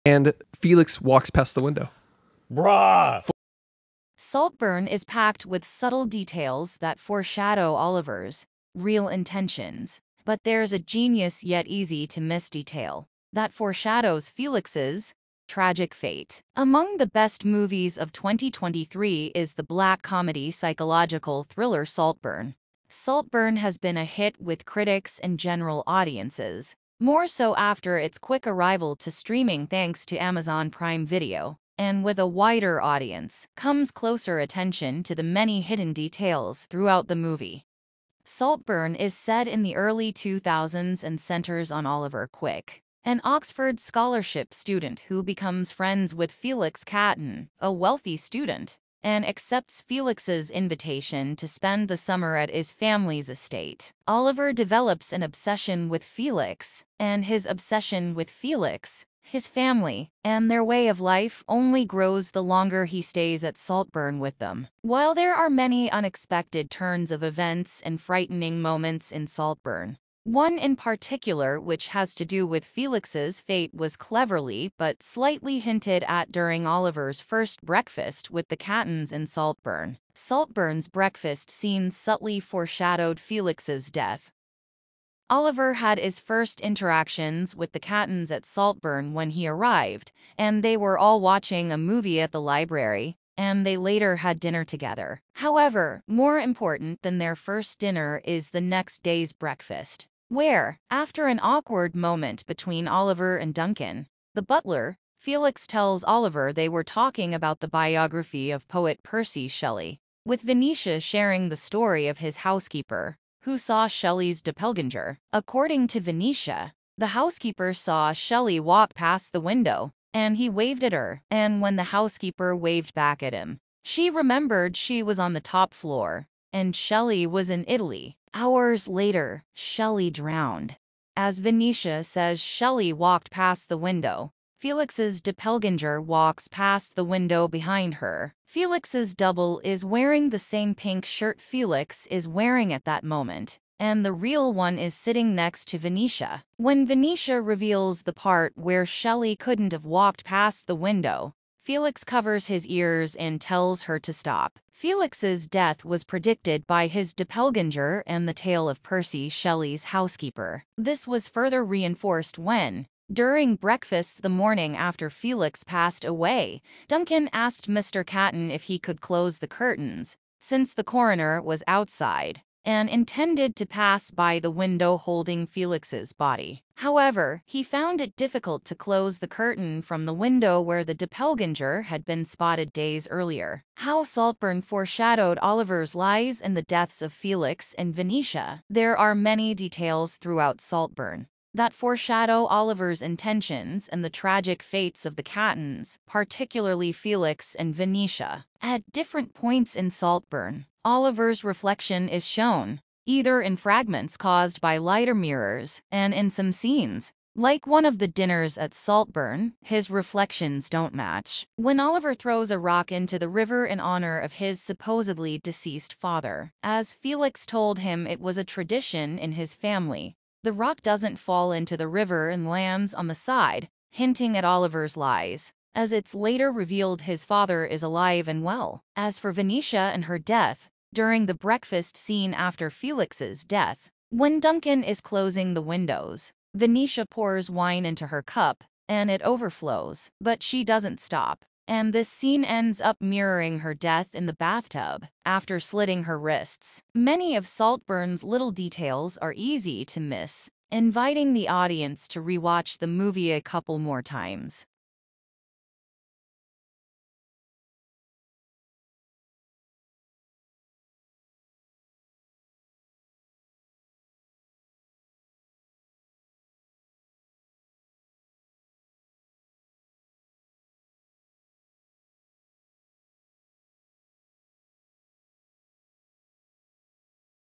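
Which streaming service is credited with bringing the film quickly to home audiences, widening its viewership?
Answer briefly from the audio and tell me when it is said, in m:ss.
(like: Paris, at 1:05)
Amazon Prime Video, at 0:30.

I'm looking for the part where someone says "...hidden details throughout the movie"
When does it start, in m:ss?
0:35.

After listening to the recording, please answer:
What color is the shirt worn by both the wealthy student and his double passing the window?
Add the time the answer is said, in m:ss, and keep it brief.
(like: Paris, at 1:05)
Pink, at 2:20.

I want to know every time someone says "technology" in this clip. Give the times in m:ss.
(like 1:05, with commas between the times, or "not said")
not said.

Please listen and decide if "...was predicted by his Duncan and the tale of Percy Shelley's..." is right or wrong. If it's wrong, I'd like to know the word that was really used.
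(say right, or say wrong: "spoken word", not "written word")
wrong: "Doppelganger", not "Duncan".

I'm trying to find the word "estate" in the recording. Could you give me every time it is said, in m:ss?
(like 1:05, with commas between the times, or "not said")
0:53.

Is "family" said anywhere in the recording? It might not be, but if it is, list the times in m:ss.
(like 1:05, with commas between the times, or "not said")
0:52, 0:59, 3:39.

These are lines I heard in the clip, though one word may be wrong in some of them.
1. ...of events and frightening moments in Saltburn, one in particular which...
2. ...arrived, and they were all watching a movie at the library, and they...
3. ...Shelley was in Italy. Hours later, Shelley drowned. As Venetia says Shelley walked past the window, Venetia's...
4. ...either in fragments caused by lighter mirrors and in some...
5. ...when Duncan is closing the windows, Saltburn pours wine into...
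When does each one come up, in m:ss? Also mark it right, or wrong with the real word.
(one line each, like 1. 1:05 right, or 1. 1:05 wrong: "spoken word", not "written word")
1. 1:07 right
2. 1:29 right
3. 2:06 wrong: "Felix", not "Venetia"
4. 3:23 right
5. 3:54 wrong: "Venetia", not "Saltburn".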